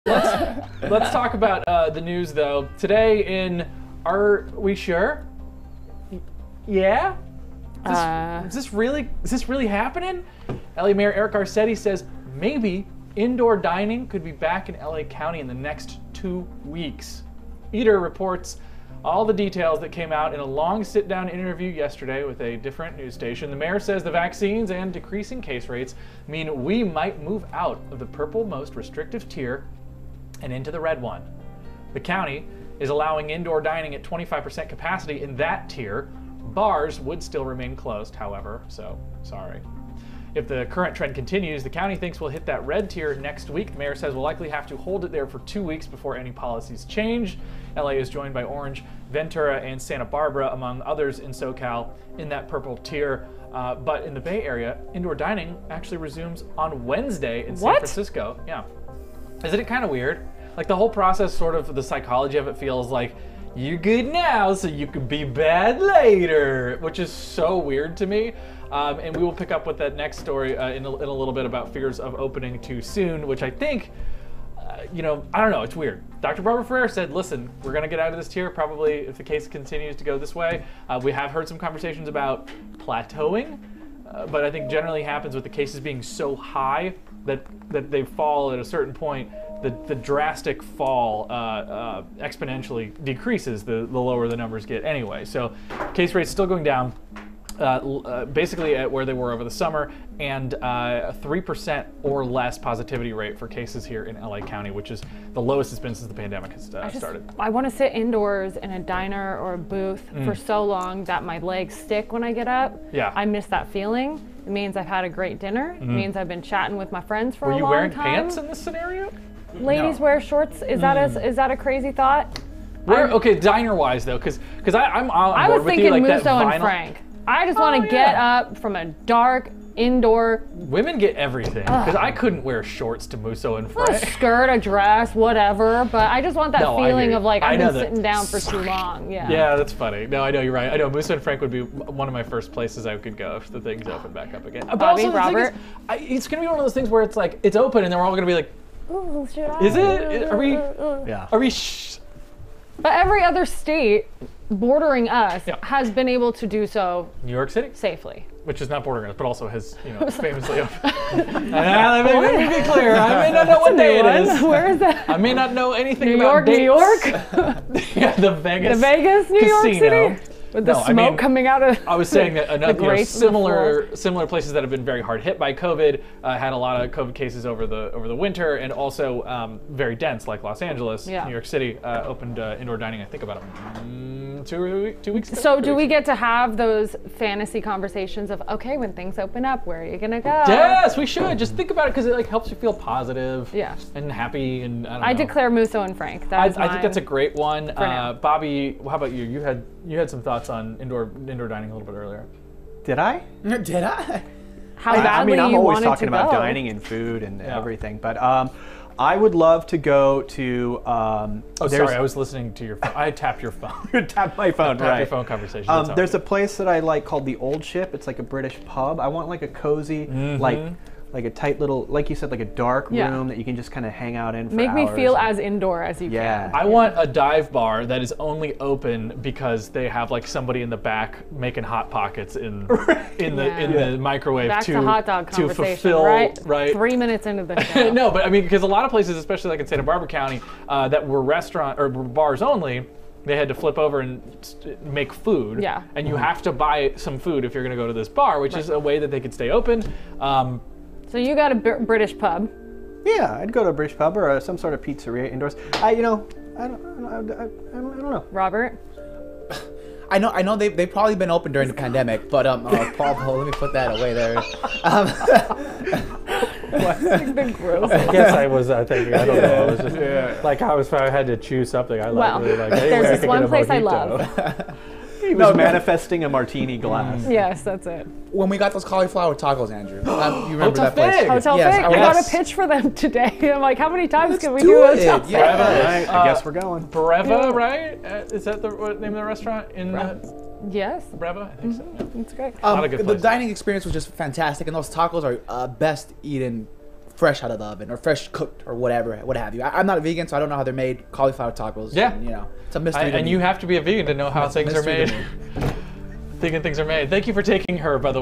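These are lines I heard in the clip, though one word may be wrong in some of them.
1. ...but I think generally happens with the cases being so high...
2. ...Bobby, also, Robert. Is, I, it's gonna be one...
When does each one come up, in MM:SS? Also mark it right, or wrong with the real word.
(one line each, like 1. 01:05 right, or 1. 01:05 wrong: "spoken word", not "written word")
1. 01:24 right
2. 02:24 right.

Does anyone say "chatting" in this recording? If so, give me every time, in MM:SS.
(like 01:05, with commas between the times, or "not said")
01:56.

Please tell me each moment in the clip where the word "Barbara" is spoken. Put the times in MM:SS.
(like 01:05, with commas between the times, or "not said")
00:50, 01:16, 03:59.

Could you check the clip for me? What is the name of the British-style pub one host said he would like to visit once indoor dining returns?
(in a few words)
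the Old Ship.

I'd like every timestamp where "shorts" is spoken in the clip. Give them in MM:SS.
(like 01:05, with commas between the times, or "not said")
02:00, 02:12.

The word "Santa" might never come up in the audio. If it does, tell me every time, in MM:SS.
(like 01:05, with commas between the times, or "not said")
00:49, 03:59.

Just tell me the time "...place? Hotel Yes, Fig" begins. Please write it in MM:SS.
04:40.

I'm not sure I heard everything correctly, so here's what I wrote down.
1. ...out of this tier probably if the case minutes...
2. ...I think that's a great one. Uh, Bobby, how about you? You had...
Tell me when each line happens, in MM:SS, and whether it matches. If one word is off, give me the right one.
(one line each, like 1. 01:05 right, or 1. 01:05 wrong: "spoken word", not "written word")
1. 01:17 wrong: "continues", not "minutes"
2. 03:16 right.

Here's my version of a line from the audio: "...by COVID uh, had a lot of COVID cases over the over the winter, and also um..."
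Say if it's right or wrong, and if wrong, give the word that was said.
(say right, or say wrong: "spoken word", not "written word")
right.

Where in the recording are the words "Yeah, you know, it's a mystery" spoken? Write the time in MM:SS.
05:01.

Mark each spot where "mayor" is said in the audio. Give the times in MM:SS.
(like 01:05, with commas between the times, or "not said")
00:10, 00:23, 00:43.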